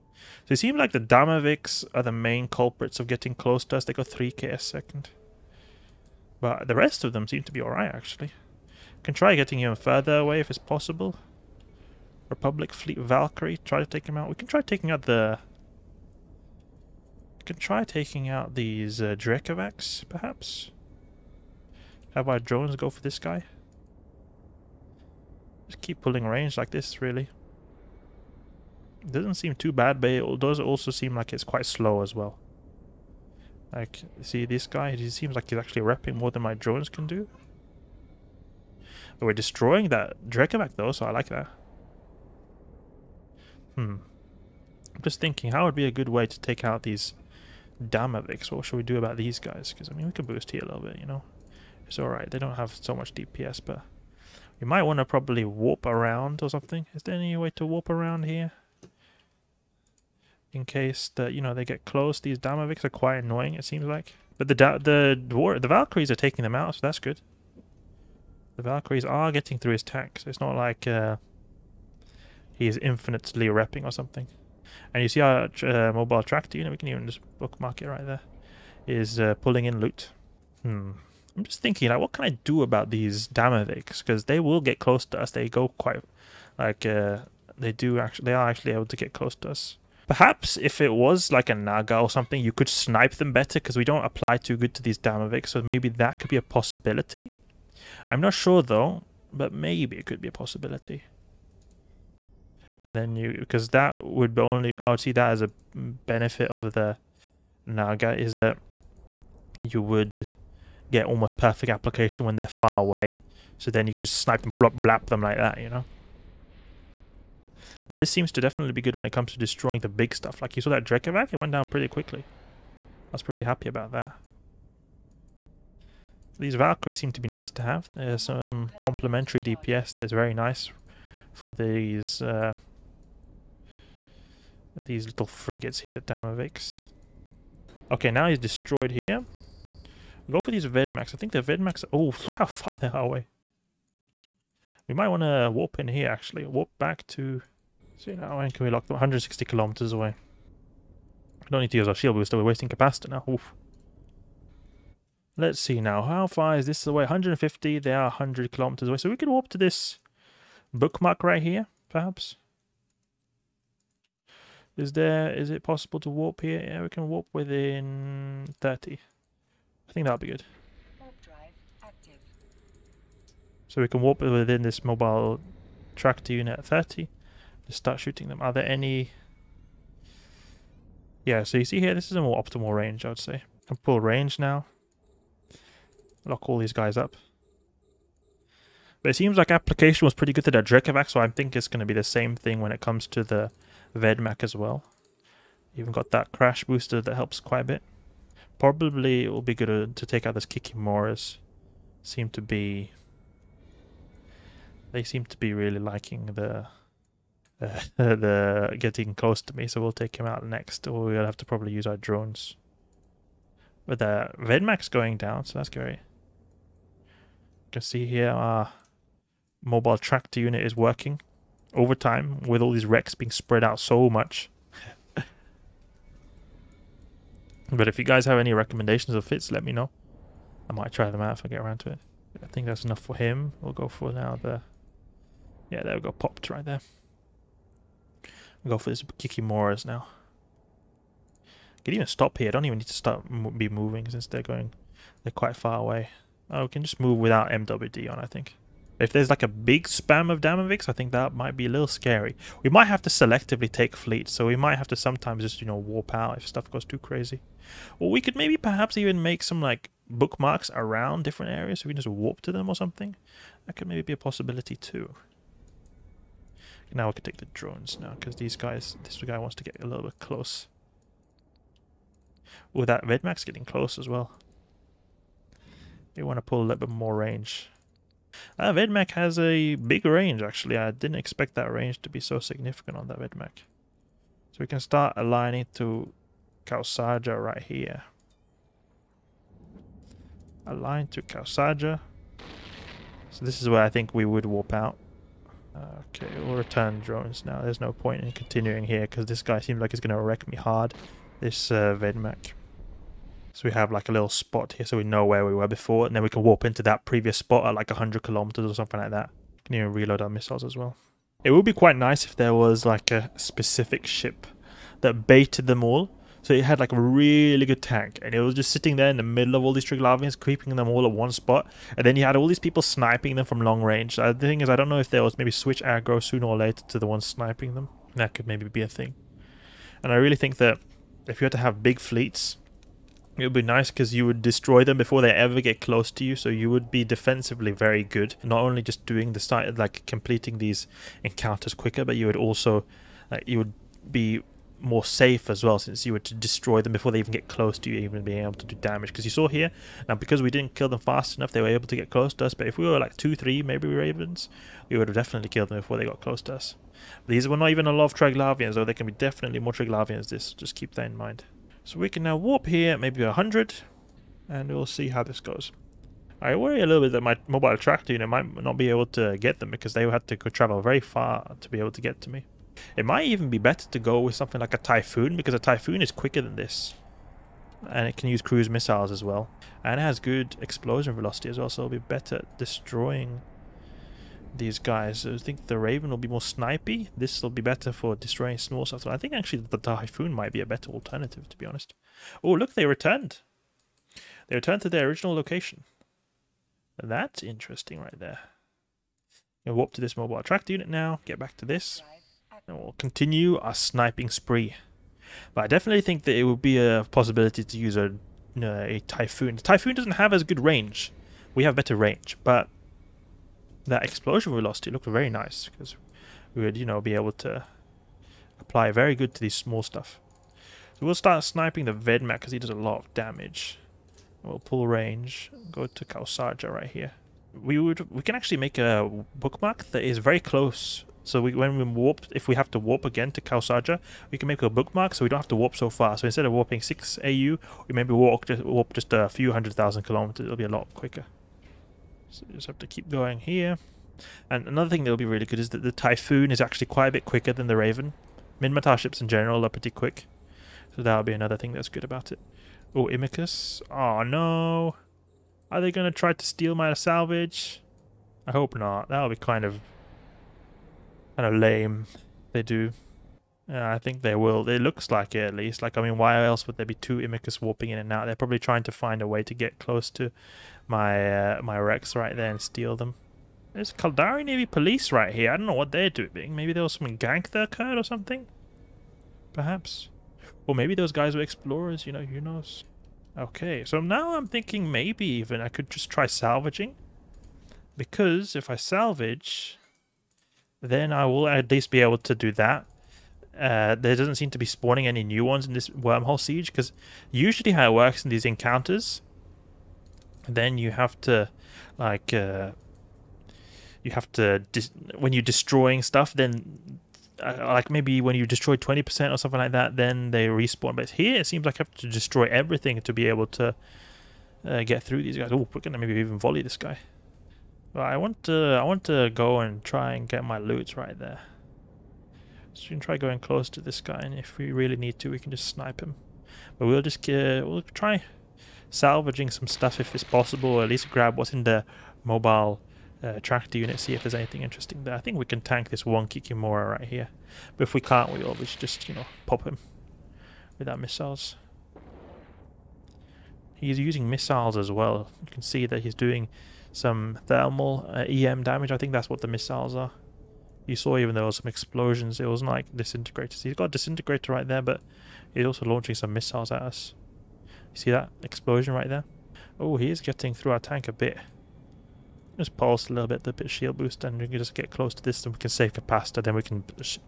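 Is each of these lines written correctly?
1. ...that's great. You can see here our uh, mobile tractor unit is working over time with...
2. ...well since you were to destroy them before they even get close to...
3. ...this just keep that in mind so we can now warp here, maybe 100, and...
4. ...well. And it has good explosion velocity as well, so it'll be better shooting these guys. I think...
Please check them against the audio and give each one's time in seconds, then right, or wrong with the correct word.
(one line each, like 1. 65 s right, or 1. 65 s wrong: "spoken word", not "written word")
1. 215 s right
2. 345 s right
3. 360 s right
4. 379 s wrong: "destroying", not "shooting".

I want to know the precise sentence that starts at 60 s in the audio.
In case that, you know, they get close.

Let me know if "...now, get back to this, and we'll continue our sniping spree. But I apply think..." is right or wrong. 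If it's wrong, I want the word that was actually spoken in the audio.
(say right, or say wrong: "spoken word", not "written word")
wrong: "definitely", not "apply".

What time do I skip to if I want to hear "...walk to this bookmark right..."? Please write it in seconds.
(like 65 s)
159 s.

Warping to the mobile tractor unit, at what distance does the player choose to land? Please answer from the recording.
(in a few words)
30.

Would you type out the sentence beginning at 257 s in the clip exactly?
Or we could maybe perhaps even make some like bookmarks around different areas so we can just warp to them or something.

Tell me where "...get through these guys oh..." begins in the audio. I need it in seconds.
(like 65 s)
514 s.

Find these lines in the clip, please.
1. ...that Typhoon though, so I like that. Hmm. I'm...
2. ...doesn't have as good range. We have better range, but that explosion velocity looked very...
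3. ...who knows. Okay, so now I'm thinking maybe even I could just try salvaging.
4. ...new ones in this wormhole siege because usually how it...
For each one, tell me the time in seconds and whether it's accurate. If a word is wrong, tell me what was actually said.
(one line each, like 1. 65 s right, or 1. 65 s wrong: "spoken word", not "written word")
1. 39 s wrong: "Drekavac", not "Typhoon"
2. 409 s right
3. 482 s right
4. 495 s right.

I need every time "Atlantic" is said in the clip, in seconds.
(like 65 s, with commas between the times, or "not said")
not said.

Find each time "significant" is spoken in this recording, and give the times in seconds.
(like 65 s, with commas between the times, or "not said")
282 s.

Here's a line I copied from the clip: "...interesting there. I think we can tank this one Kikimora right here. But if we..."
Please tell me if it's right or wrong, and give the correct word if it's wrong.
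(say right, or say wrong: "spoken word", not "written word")
right.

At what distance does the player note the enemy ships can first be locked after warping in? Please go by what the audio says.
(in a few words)
160 kilometers.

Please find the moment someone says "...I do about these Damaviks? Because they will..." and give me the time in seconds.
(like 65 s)
82 s.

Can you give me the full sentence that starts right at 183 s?
I can pull range now lock all these guys up.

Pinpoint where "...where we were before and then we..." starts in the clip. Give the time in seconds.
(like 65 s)
305 s.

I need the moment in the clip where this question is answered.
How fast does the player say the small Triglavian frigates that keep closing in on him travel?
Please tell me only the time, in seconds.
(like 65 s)
4 s.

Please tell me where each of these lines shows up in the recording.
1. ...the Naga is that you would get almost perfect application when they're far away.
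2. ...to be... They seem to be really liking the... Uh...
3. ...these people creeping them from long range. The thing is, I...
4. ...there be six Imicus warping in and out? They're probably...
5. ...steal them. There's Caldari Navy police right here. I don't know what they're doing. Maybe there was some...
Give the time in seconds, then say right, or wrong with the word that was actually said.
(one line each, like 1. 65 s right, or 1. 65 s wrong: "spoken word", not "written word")
1. 106 s right
2. 202 s right
3. 322 s wrong: "sniping", not "creeping"
4. 466 s wrong: "two", not "six"
5. 472 s right.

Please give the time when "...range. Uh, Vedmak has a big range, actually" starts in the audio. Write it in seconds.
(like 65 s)
277 s.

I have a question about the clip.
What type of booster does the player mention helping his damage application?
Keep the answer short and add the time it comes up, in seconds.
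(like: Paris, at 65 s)
crash booster, at 196 s.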